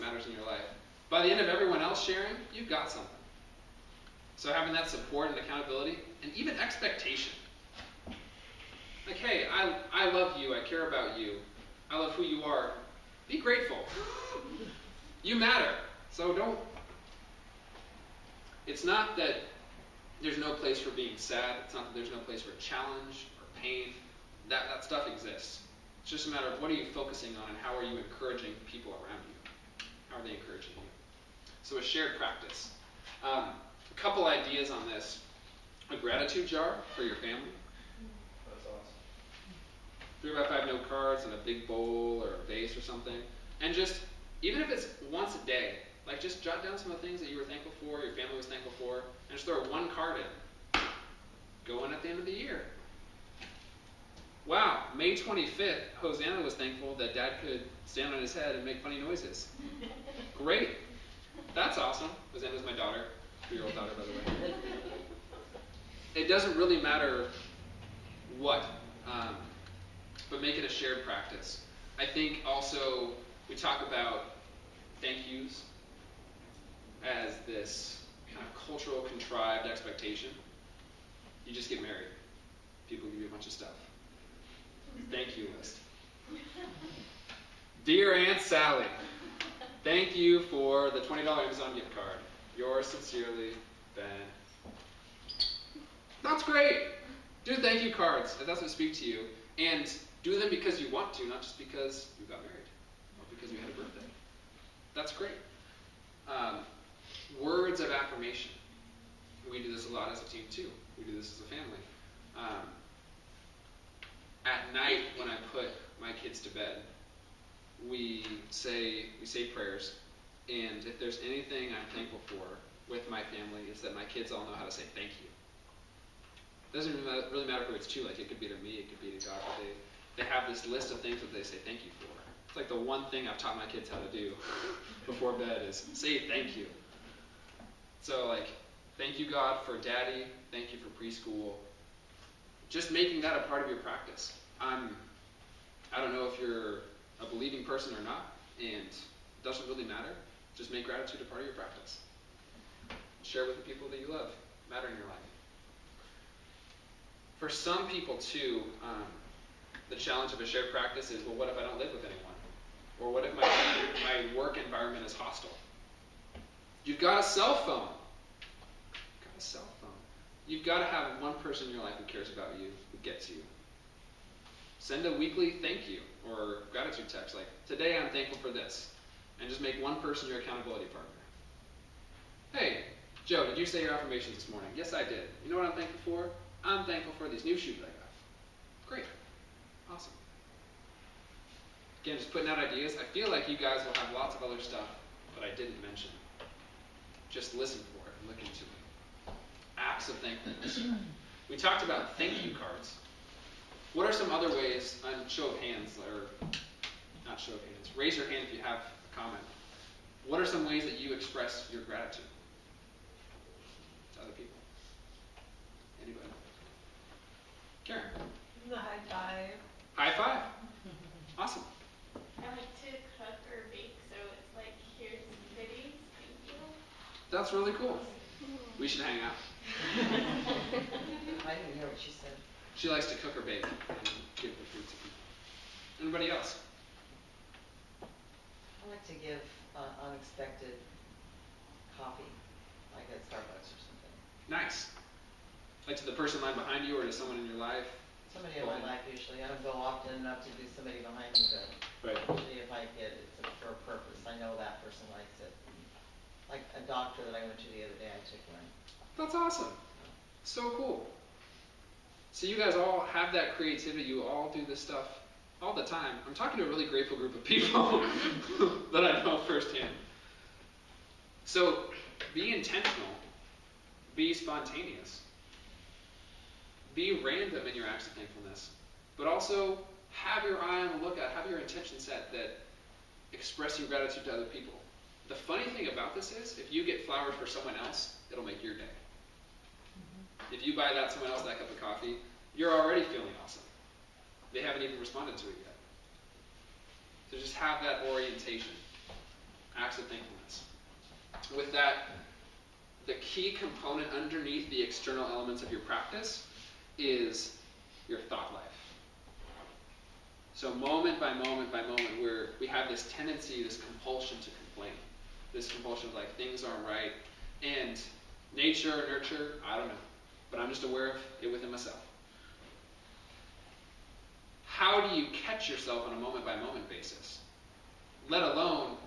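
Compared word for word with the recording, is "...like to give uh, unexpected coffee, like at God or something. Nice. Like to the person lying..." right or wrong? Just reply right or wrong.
wrong.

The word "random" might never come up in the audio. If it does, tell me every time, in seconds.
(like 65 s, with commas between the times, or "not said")
277 s.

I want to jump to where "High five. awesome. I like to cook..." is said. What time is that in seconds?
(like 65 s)
219 s.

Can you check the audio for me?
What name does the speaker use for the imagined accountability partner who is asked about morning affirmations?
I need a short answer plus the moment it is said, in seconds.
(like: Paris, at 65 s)
Joe, at 183 s.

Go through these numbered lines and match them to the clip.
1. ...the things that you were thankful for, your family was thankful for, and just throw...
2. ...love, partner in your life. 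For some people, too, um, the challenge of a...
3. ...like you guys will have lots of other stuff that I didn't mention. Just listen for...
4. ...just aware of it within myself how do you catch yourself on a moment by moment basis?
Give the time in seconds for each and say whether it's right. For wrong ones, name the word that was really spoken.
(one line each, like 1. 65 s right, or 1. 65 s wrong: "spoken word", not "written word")
1. 47 s right
2. 154 s wrong: "matter", not "partner"
3. 193 s right
4. 320 s right.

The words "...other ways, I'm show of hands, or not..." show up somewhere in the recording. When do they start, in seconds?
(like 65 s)
204 s.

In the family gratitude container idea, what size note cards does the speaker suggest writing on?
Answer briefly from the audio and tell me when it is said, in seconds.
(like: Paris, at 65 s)
3 by 5, at 40 s.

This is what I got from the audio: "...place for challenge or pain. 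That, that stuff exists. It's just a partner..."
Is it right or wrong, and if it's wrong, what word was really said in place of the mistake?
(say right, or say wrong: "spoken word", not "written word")
wrong: "matter", not "partner".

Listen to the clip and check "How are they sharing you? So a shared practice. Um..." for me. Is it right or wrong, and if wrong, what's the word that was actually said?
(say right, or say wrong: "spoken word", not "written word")
wrong: "encouraging", not "sharing".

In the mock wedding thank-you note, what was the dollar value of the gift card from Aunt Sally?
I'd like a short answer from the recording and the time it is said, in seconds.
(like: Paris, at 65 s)
$20, at 91 s.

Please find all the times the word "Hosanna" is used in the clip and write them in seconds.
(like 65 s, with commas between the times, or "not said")
56 s, 62 s.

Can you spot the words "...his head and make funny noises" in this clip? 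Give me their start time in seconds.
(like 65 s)
58 s.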